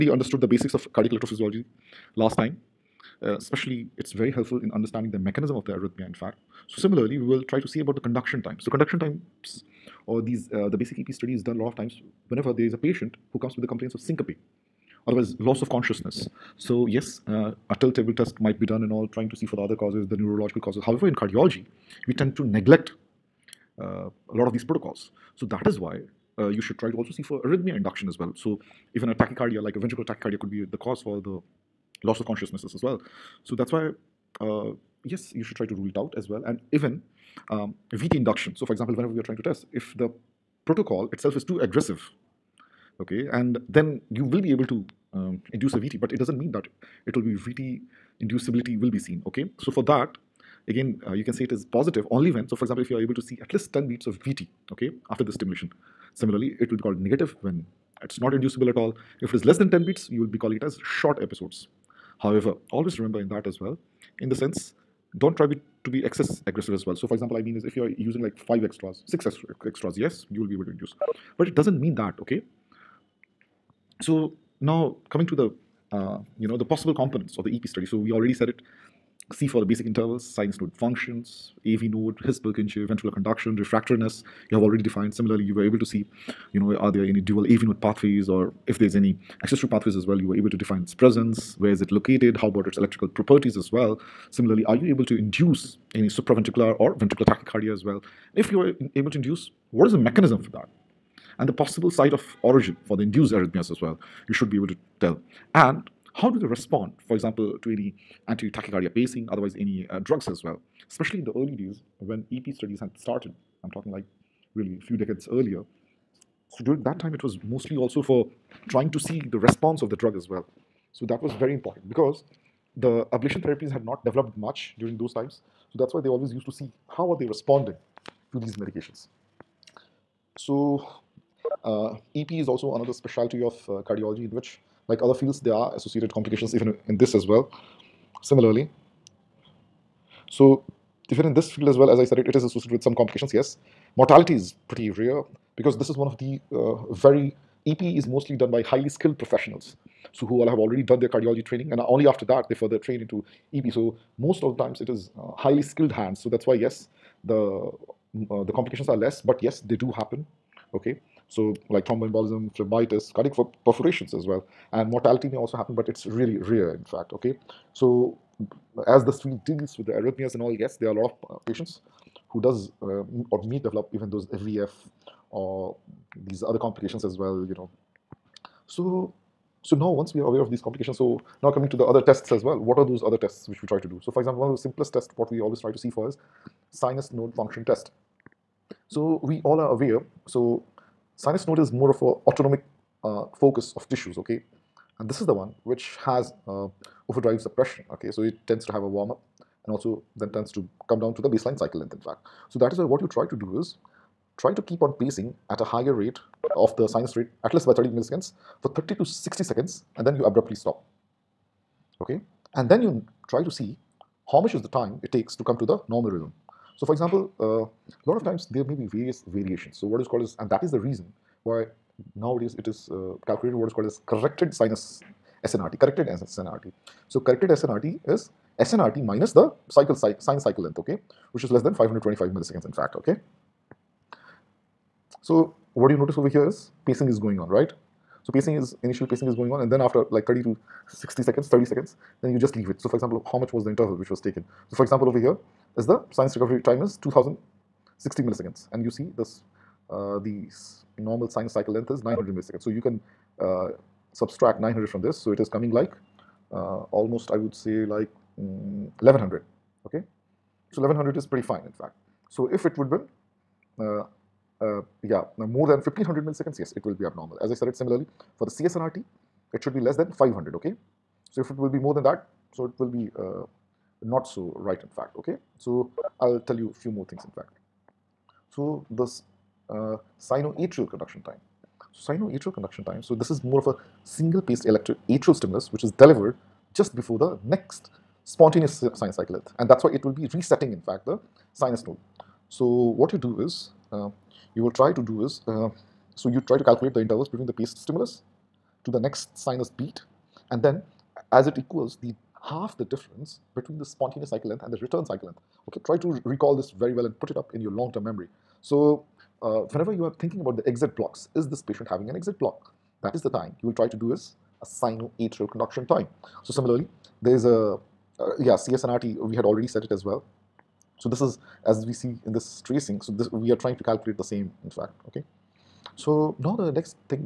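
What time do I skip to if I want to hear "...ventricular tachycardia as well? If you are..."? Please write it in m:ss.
1:36.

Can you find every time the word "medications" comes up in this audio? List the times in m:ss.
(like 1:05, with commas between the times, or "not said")
2:08.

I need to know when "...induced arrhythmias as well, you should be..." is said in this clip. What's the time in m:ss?
1:43.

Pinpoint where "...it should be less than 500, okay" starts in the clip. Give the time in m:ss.
4:29.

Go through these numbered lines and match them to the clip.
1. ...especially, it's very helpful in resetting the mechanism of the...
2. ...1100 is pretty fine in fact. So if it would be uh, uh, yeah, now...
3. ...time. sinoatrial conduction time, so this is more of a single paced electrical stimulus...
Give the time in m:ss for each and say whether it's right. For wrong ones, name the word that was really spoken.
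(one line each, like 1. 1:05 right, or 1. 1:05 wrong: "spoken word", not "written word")
1. 0:03 wrong: "understanding", not "resetting"
2. 4:20 right
3. 4:41 wrong: "atrial", not "electrical".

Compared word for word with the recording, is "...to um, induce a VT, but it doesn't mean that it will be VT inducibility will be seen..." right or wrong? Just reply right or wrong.
right.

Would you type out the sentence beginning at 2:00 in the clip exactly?
So that was very important because the ablation therapies had not developed much during those times.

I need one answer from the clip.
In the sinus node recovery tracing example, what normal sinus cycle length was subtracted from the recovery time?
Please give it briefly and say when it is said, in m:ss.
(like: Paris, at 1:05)
900 milliseconds, at 4:12.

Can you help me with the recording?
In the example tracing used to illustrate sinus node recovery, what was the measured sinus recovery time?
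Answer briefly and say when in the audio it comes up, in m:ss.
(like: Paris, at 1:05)
2060 milliseconds, at 4:07.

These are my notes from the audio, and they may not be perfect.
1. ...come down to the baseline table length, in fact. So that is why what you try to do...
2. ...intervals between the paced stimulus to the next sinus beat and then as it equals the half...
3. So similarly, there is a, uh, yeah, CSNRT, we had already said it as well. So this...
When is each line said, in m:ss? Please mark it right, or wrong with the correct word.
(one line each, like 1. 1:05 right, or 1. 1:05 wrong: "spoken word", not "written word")
1. 3:20 wrong: "cycle", not "table"
2. 4:57 right
3. 5:16 right.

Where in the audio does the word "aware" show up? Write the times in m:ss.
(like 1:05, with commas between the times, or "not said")
3:00, 3:09.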